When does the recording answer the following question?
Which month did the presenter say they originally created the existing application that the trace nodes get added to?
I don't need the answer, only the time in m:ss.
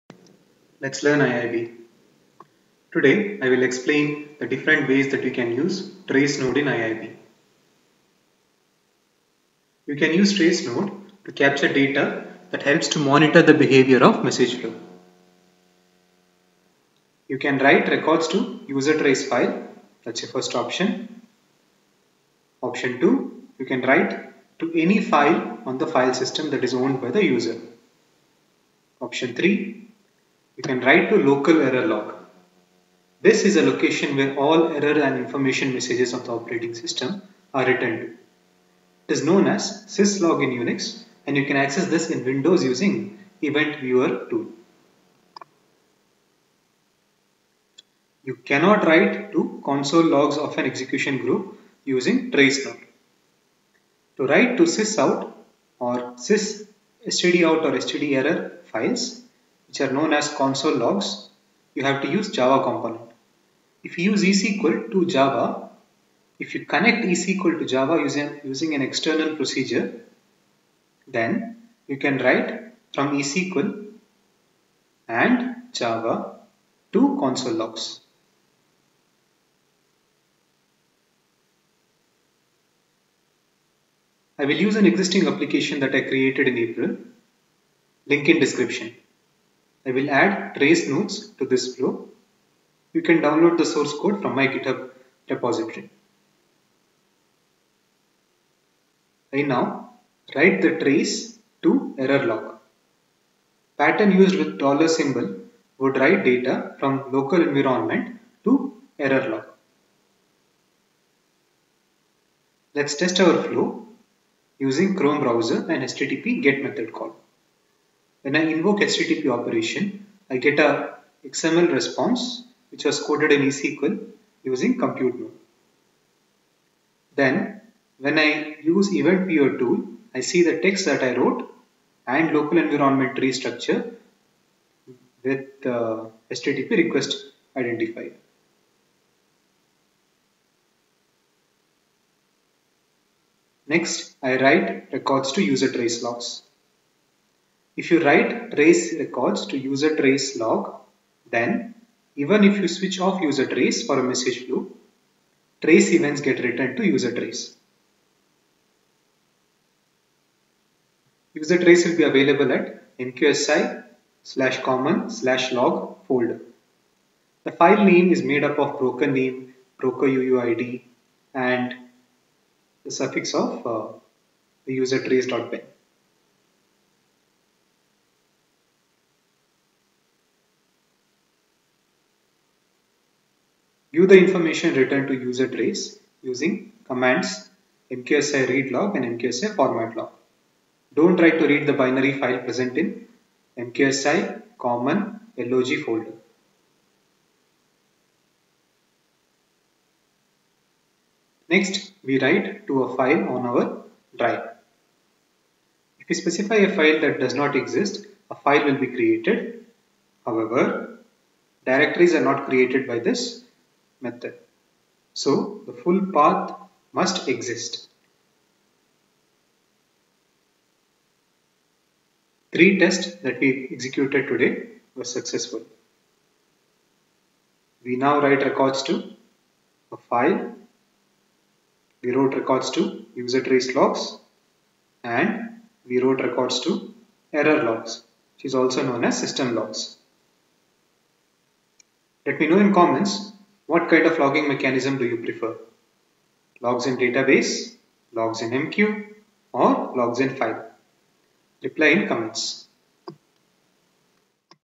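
1:26.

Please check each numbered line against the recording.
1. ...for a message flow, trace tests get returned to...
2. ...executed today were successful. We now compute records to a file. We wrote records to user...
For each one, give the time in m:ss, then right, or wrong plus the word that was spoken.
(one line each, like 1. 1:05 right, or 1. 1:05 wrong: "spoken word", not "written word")
1. 2:33 wrong: "events", not "tests"
2. 3:43 wrong: "write", not "compute".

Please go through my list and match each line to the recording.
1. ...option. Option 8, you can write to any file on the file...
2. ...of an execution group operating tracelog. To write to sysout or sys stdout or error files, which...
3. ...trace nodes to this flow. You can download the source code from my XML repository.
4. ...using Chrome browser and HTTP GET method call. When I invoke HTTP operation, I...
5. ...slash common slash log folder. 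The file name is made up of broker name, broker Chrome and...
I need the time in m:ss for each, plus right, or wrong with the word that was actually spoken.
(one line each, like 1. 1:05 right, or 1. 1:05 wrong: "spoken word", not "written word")
1. 0:20 wrong: "2", not "8"
2. 0:50 wrong: "using", not "operating"
3. 1:30 wrong: "GitHub", not "XML"
4. 1:54 right
5. 2:44 wrong: "UUID", not "Chrome".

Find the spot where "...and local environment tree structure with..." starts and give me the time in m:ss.
2:12.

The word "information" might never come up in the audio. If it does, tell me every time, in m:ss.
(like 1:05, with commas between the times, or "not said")
0:35, 3:04.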